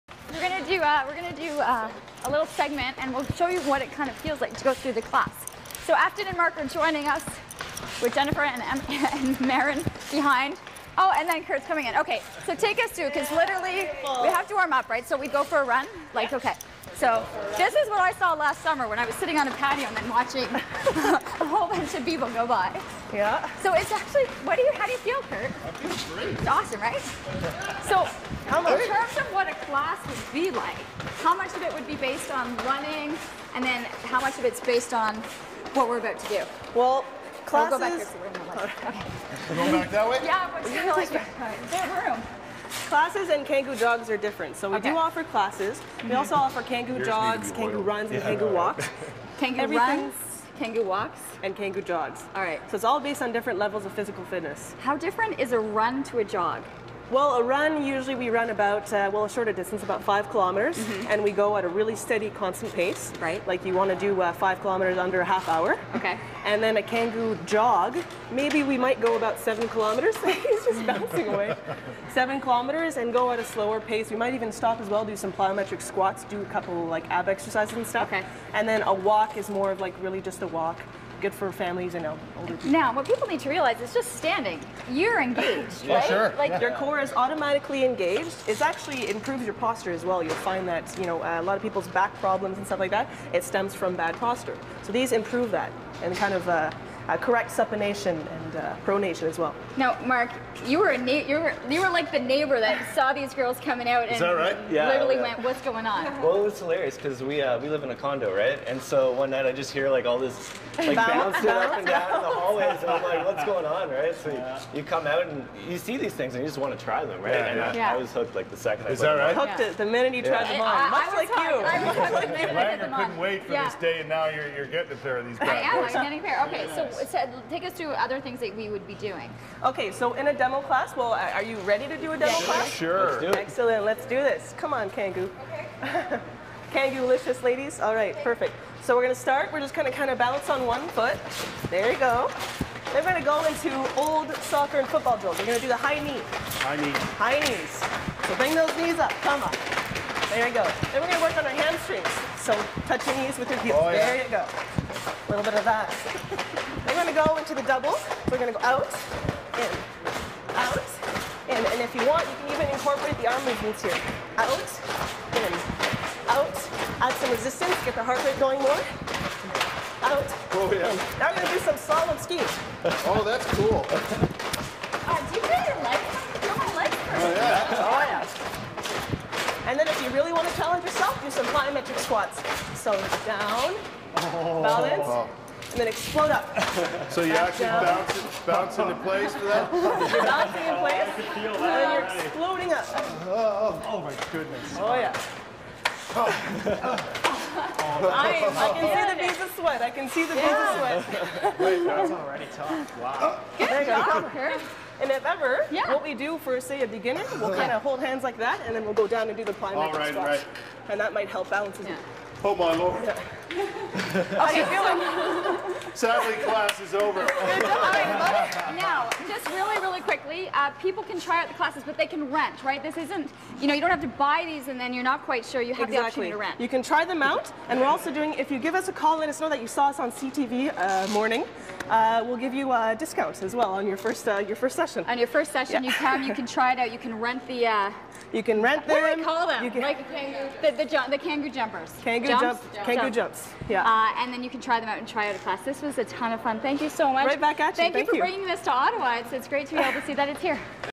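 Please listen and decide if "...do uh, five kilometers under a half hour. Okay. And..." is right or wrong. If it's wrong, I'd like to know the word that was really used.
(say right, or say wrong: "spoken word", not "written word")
right.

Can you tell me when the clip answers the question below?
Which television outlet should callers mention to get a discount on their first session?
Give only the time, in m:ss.
3:50.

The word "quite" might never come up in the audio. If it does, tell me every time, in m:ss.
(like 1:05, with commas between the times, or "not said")
3:45.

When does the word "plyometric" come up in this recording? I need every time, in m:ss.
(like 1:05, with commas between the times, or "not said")
1:15, 3:01, 3:29.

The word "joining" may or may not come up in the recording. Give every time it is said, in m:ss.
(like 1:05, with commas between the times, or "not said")
0:06.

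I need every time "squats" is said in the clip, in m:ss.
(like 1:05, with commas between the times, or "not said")
1:15, 3:01, 3:30.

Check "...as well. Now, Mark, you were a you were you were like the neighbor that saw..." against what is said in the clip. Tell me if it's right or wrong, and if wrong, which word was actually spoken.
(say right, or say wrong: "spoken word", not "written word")
right.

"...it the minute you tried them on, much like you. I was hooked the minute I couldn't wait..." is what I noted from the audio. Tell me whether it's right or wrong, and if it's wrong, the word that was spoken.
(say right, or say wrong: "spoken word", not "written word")
right.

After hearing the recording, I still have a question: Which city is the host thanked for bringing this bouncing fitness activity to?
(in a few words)
Ottawa.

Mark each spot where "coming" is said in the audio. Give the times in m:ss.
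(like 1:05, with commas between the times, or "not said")
0:11, 1:43.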